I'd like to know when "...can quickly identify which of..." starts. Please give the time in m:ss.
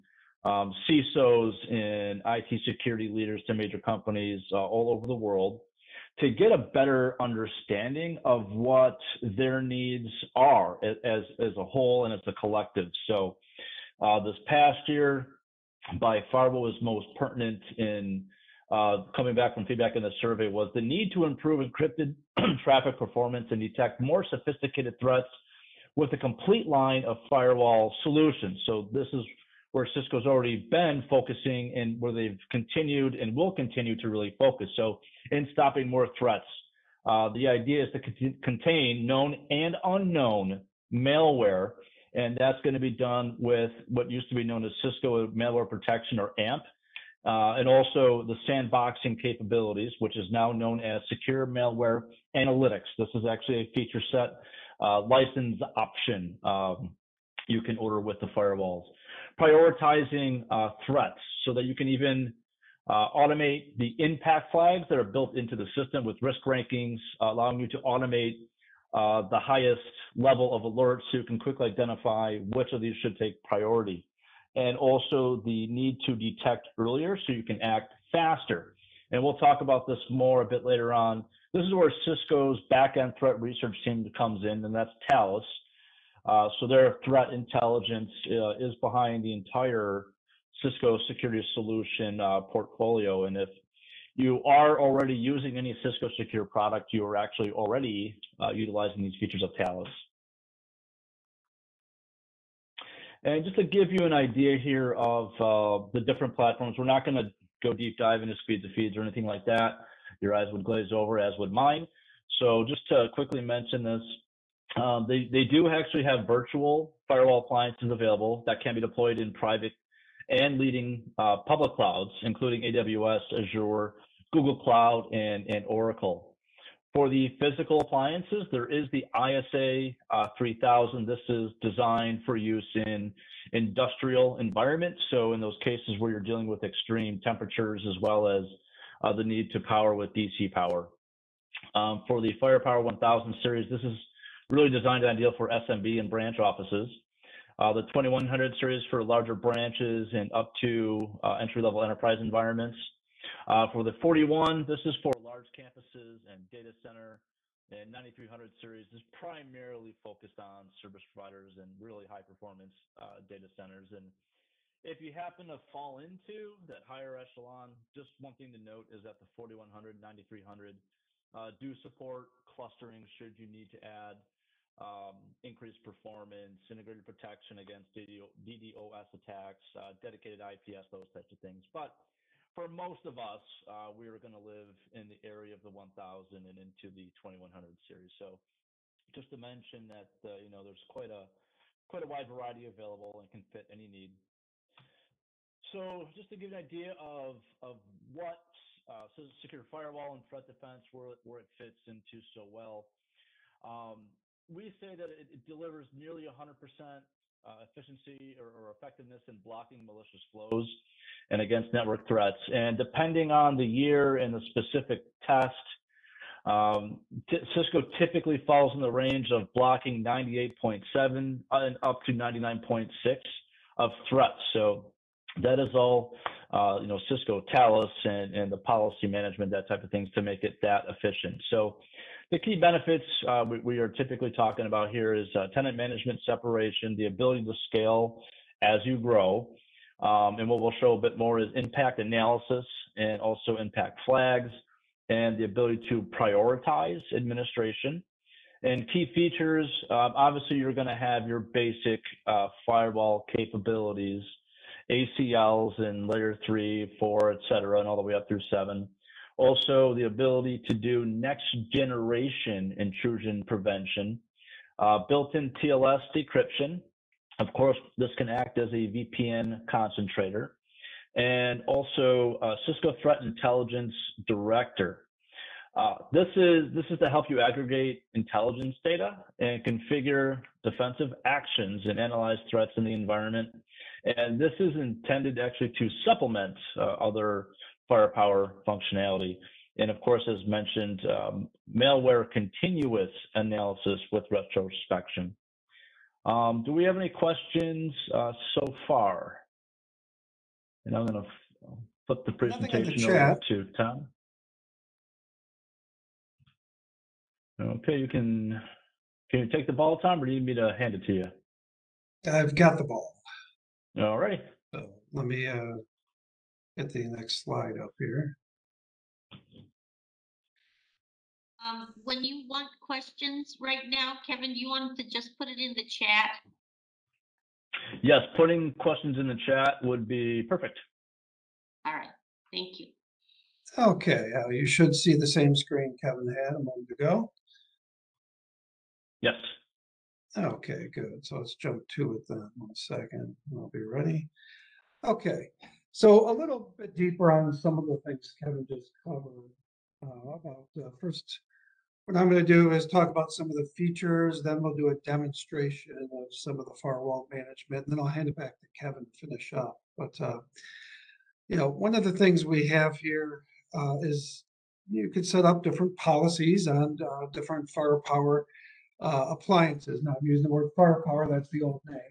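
1:11.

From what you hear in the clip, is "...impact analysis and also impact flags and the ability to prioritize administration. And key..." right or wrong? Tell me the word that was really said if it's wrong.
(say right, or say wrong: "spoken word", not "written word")
right.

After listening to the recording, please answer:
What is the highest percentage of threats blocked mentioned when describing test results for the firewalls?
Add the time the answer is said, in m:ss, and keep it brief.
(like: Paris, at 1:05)
99.6, at 3:42.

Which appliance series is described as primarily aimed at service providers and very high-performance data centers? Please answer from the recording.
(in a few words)
9300 series.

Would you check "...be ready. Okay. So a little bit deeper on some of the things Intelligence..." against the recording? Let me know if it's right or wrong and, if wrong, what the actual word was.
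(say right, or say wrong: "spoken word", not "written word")
wrong: "Kevin", not "Intelligence".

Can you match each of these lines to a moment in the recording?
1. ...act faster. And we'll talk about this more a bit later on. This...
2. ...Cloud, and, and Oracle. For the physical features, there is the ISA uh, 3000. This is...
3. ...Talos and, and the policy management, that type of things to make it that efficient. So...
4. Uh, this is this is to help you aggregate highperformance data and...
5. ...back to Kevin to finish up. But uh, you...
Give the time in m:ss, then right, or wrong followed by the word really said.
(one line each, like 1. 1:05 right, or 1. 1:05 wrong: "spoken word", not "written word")
1. 1:17 right
2. 2:04 wrong: "appliances", not "features"
3. 3:47 right
4. 4:35 wrong: "intelligence", not "highperformance"
5. 5:58 right.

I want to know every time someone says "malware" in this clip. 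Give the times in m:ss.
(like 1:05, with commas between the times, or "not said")
0:40, 0:45, 0:51, 4:51.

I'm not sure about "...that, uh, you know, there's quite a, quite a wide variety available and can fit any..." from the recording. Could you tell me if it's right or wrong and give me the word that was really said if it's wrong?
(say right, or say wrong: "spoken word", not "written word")
right.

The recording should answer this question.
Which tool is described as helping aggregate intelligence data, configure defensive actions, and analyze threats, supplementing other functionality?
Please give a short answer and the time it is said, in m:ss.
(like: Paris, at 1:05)
Cisco Threat Intelligence Director, at 4:32.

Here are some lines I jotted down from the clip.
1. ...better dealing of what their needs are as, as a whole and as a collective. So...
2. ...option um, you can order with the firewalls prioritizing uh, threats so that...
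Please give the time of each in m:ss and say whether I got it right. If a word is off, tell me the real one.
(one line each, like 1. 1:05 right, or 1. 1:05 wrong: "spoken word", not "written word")
1. 0:06 wrong: "understanding", not "dealing"
2. 0:55 right.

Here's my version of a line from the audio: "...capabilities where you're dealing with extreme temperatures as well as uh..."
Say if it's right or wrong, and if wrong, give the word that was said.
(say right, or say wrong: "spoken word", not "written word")
wrong: "cases", not "capabilities".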